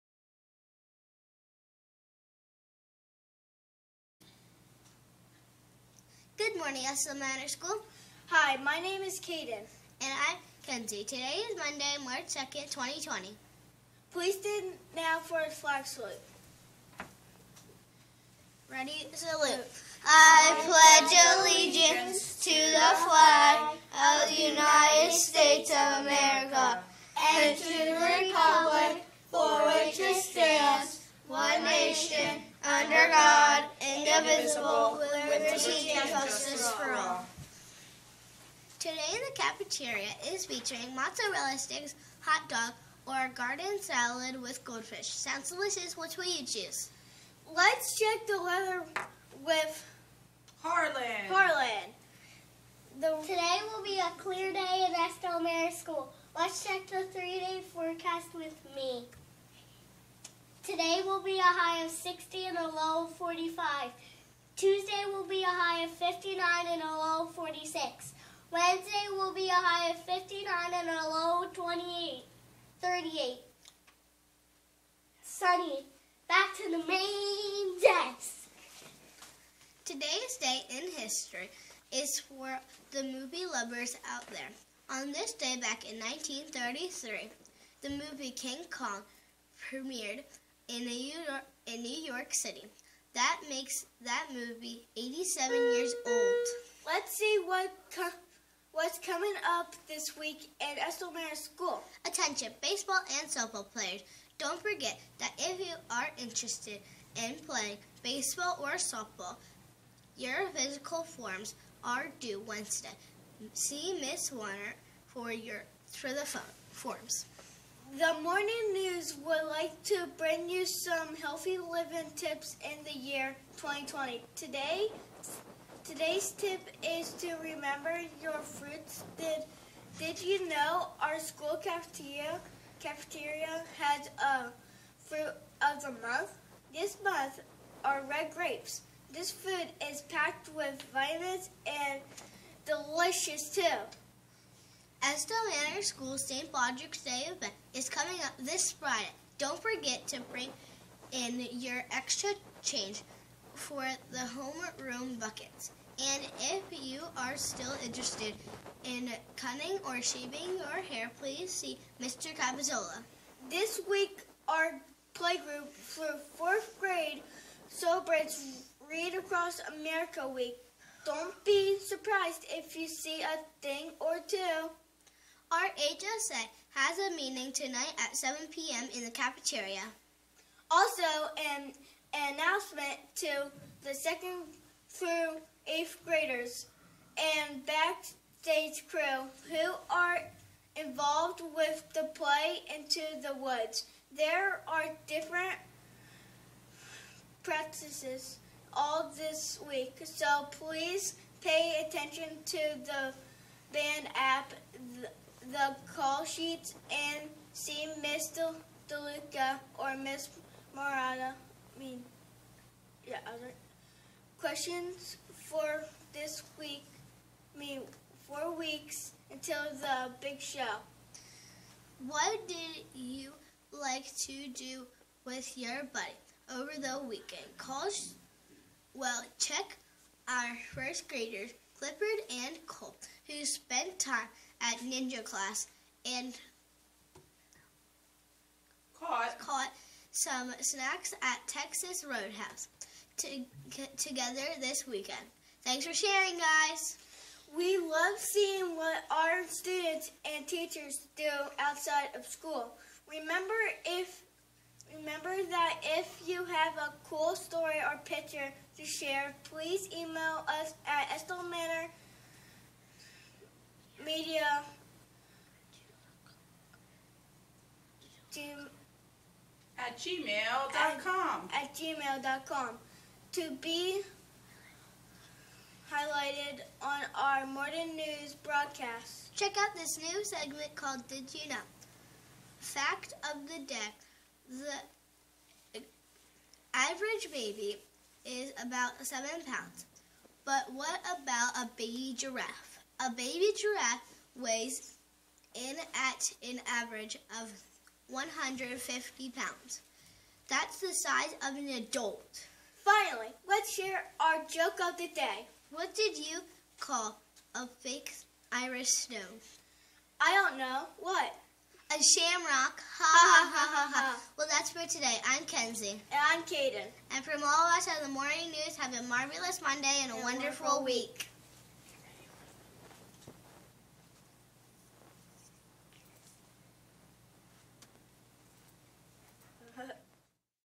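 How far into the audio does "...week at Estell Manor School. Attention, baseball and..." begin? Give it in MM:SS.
01:40.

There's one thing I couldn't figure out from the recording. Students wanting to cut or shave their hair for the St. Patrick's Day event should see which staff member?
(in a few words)
Mr. Capizola.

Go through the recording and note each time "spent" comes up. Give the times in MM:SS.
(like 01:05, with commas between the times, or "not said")
03:53.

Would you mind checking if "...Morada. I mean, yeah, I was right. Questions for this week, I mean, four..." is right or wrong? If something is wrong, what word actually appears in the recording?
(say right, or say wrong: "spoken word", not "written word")
right.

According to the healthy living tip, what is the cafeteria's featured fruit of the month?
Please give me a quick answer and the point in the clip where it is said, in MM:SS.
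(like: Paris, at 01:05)
red grapes, at 02:18.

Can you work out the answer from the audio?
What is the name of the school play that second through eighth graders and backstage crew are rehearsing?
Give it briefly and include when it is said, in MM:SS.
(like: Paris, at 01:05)
Into the Woods, at 03:12.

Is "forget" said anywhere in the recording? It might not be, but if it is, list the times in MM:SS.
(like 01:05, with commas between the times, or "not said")
01:44, 02:29.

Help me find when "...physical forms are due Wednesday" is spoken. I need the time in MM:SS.
01:50.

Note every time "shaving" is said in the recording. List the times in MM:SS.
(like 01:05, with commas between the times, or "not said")
02:40.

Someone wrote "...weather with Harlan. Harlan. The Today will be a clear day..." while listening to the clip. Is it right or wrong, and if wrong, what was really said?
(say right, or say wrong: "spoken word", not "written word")
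right.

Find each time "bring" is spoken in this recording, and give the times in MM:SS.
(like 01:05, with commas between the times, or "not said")
02:00, 02:30.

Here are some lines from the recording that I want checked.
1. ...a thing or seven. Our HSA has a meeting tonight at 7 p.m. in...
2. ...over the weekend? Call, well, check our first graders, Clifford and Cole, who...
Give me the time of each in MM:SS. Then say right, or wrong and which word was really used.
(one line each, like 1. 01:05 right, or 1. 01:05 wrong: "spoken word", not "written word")
1. 02:53 wrong: "two", not "seven"
2. 03:46 right.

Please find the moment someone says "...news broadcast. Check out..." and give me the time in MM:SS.
04:37.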